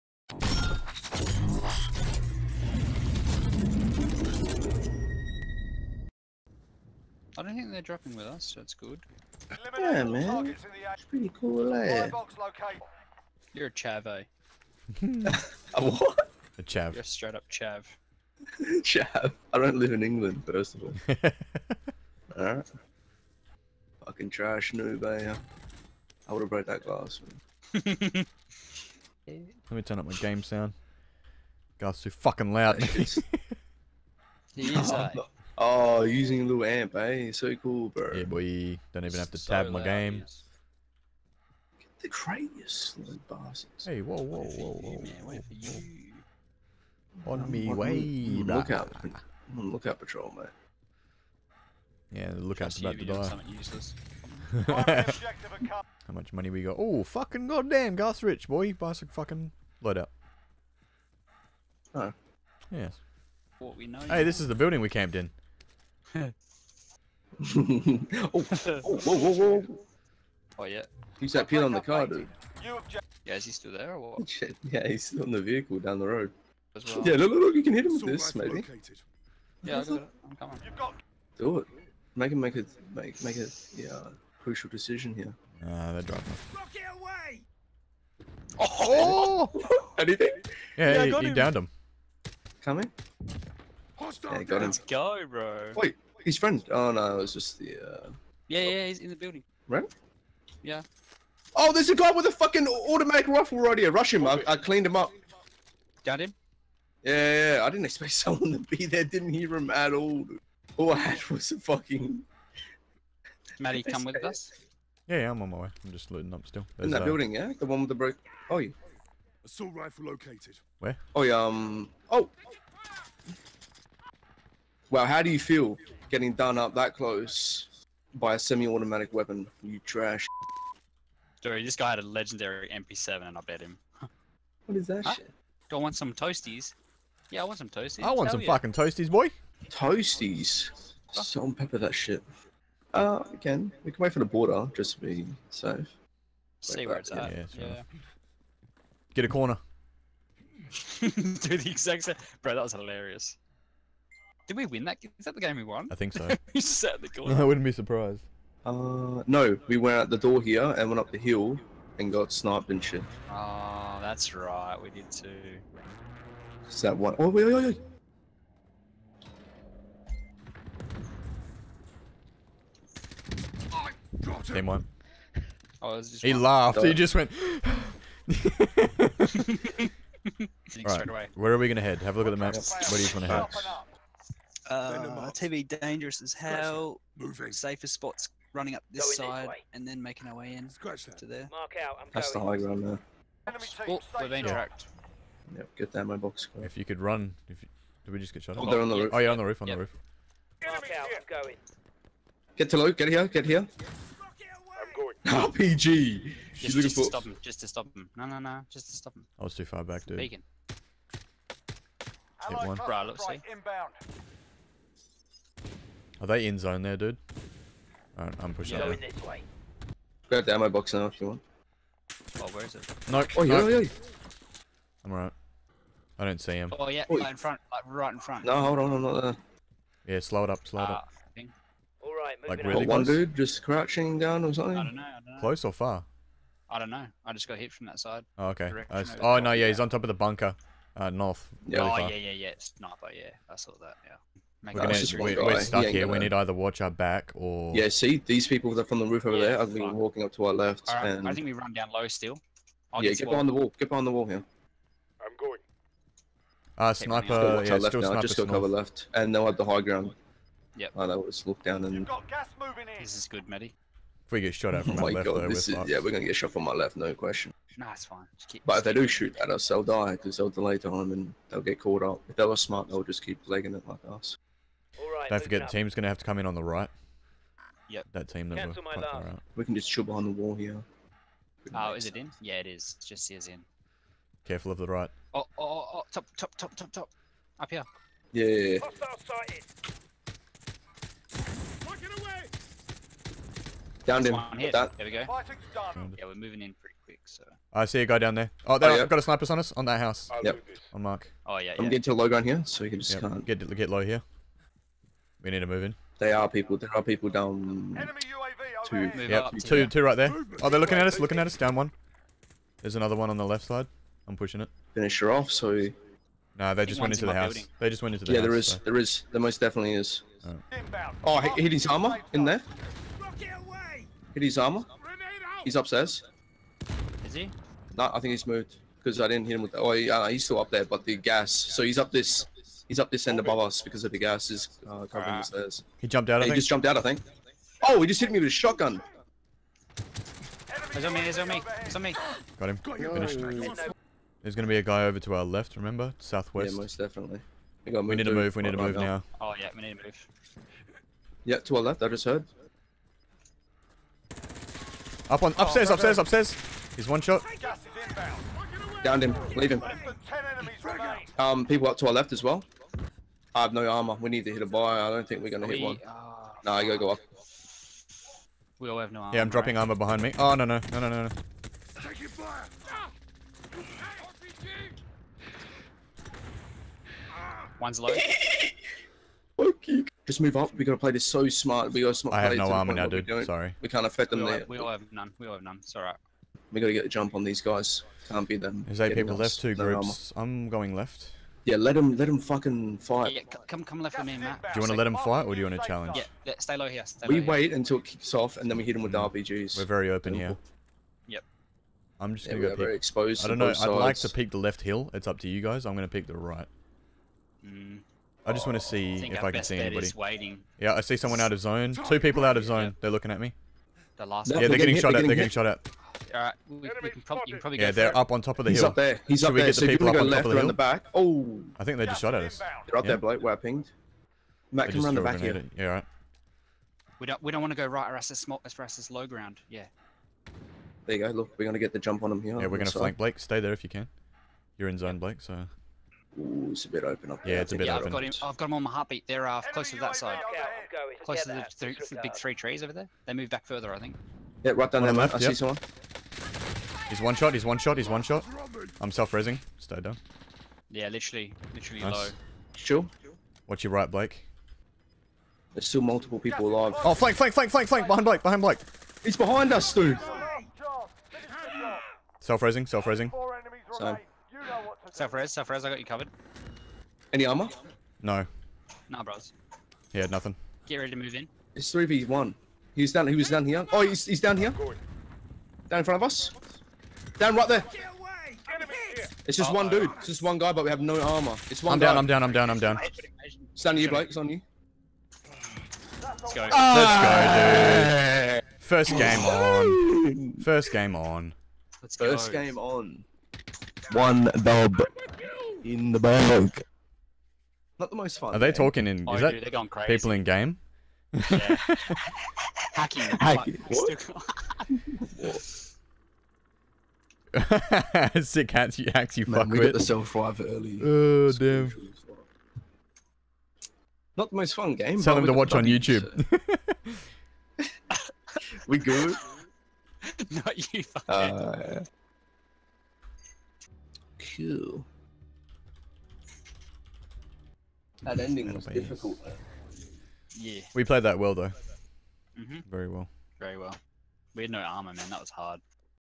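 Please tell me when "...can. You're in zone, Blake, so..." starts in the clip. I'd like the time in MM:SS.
07:13.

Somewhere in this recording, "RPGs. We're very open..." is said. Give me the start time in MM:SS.
06:39.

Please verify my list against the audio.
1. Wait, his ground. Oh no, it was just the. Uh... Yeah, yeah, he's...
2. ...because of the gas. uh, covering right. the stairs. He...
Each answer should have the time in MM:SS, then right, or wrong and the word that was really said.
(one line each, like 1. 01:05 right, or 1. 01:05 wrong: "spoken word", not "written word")
1. 01:35 wrong: "friend", not "ground"
2. 05:33 right.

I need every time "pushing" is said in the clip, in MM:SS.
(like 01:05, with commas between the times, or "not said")
03:38, 05:14.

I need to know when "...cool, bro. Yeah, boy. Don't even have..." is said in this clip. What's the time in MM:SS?
00:37.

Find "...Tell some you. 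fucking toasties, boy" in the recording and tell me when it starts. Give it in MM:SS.
02:18.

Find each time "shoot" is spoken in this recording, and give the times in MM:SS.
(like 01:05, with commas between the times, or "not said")
04:29, 04:39.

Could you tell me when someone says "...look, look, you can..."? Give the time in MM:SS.
01:17.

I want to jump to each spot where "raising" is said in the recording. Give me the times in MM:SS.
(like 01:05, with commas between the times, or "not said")
07:29, 07:42.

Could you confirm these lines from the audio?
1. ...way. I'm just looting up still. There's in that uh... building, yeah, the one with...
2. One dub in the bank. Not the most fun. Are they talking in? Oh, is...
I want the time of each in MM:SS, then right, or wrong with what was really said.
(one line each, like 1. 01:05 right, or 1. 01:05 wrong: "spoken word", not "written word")
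1. 01:55 right
2. 08:14 right.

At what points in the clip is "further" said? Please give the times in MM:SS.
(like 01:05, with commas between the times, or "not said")
07:23.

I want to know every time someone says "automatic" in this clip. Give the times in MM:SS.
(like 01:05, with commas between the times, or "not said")
01:42, 02:08.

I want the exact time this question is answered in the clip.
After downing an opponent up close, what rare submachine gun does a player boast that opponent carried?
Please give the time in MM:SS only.
02:12.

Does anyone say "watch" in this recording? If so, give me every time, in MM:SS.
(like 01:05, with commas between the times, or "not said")
04:06, 07:33, 08:35.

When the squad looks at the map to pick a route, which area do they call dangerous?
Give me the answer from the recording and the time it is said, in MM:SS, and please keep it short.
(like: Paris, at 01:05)
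TV, at 03:05.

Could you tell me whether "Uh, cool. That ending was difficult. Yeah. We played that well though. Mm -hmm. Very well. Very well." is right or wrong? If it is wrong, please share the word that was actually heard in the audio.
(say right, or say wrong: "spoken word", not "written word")
right.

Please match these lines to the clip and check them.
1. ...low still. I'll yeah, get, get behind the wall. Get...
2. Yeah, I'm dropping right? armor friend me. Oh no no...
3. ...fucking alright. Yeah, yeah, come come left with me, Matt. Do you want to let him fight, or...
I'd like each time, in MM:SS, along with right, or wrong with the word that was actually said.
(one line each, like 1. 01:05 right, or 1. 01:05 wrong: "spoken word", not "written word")
1. 04:11 right
2. 06:09 wrong: "behind", not "friend"
3. 06:32 wrong: "fight", not "alright".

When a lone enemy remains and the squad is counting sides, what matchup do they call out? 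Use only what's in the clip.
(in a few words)
3v1.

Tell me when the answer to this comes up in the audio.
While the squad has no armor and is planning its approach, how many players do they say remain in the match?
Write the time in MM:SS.
06:29.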